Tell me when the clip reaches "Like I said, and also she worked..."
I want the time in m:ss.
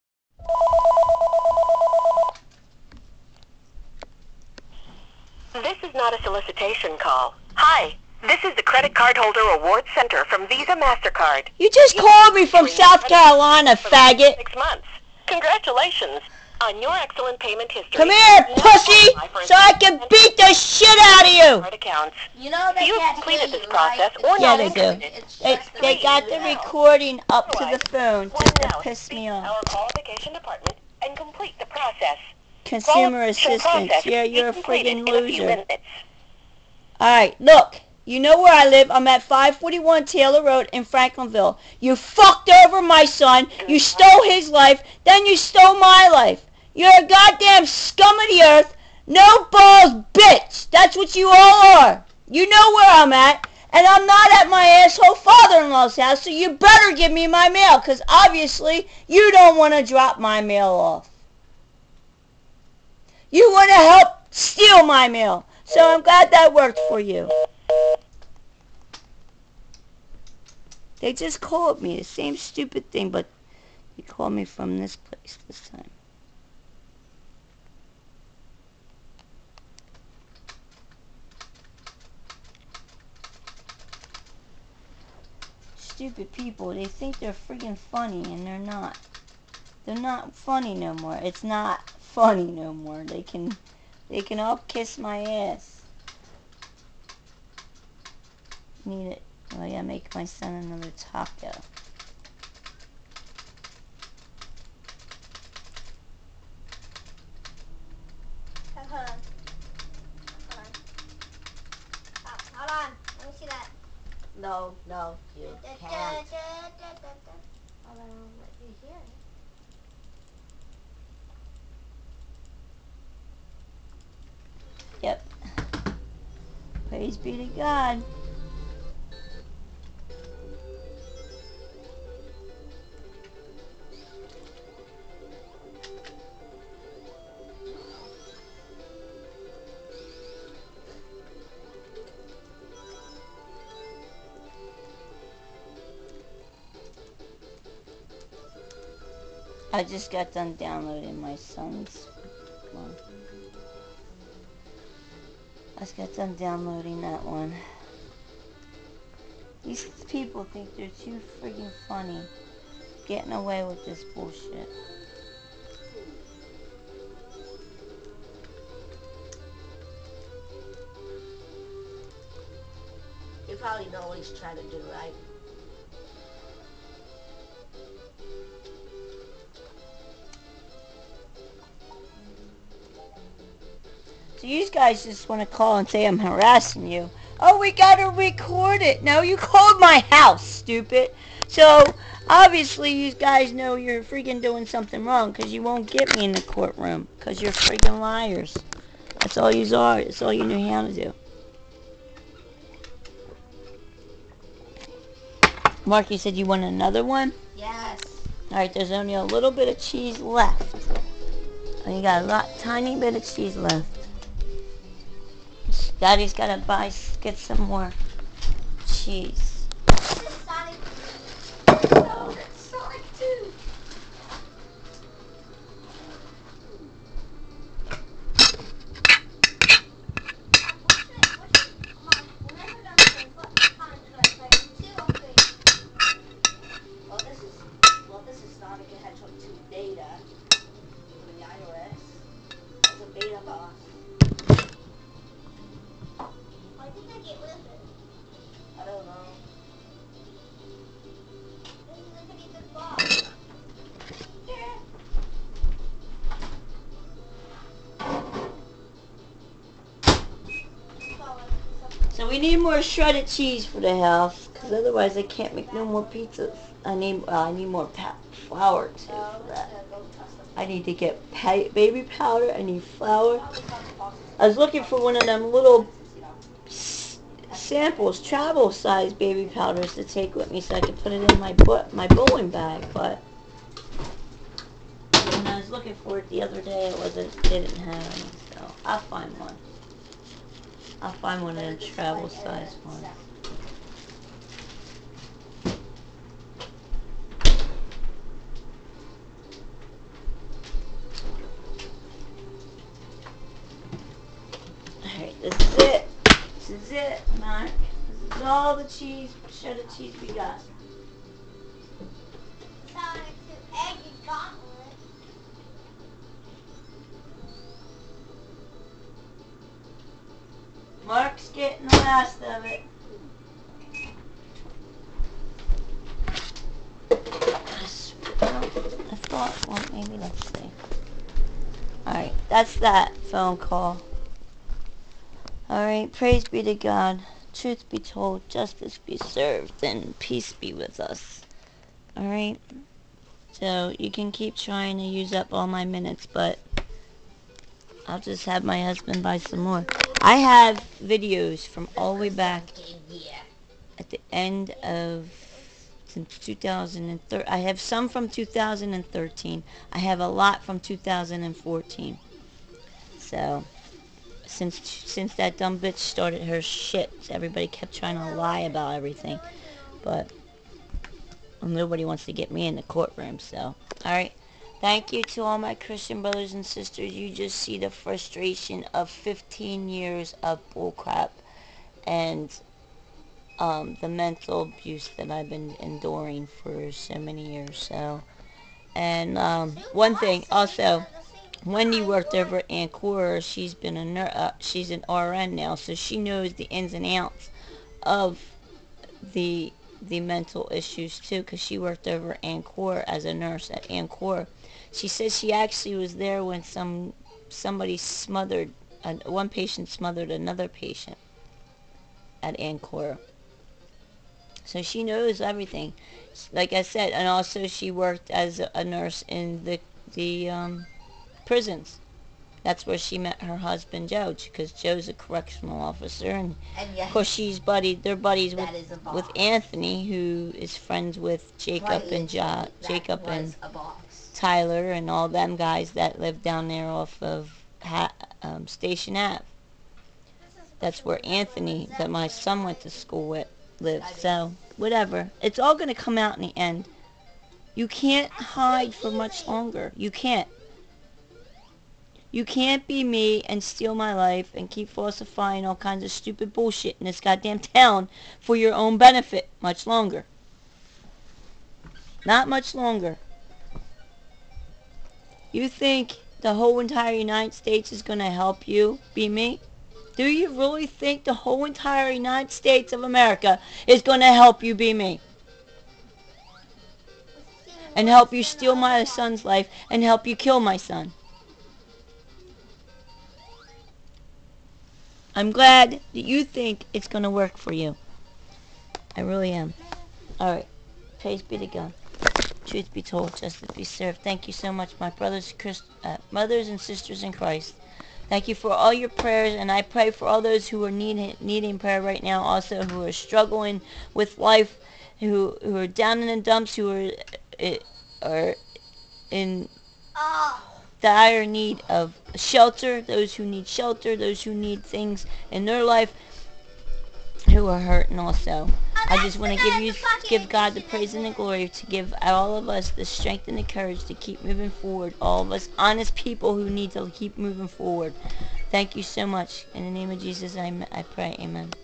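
6:56.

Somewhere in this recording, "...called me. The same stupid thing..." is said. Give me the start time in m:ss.
1:11.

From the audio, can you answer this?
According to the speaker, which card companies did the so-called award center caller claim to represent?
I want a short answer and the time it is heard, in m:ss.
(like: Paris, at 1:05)
Visa MasterCard, at 0:10.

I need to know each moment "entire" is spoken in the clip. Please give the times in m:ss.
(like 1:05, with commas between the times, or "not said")
7:46, 7:51.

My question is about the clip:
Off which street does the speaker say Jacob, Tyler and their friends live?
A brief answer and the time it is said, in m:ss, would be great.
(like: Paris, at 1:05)
Station Ave, at 7:18.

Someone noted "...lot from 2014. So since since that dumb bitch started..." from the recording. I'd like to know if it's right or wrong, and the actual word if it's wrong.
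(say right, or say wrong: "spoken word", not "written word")
right.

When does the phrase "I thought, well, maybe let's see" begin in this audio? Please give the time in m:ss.
5:29.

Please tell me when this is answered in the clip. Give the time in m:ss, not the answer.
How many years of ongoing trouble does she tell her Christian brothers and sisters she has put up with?
6:19.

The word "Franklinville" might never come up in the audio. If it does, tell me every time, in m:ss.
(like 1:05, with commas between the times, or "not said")
0:40.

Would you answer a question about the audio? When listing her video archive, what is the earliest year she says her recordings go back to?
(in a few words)
2003.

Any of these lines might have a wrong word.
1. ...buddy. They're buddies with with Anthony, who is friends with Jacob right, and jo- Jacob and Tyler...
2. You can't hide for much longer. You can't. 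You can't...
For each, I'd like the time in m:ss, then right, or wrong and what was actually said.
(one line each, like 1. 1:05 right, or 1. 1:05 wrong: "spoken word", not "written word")
1. 7:07 right
2. 7:27 right.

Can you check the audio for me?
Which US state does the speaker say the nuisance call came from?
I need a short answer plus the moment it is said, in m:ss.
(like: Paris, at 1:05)
South Carolina, at 0:12.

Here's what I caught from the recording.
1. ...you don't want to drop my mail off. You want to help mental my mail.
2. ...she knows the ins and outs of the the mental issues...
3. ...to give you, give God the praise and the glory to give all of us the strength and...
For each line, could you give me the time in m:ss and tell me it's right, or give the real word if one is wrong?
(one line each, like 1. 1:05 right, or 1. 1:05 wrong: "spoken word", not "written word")
1. 0:59 wrong: "steal", not "mental"
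2. 6:35 right
3. 8:39 right.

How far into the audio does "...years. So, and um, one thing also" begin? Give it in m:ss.
6:27.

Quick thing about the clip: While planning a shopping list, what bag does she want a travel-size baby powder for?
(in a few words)
bowling bag.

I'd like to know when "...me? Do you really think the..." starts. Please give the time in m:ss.
7:49.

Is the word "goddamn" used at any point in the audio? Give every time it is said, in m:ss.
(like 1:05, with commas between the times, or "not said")
0:47, 7:37.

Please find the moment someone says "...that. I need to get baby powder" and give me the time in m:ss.
4:29.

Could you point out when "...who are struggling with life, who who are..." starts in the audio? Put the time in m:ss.
8:22.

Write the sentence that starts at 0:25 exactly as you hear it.
They, they got the recording up to the phone to piss me off.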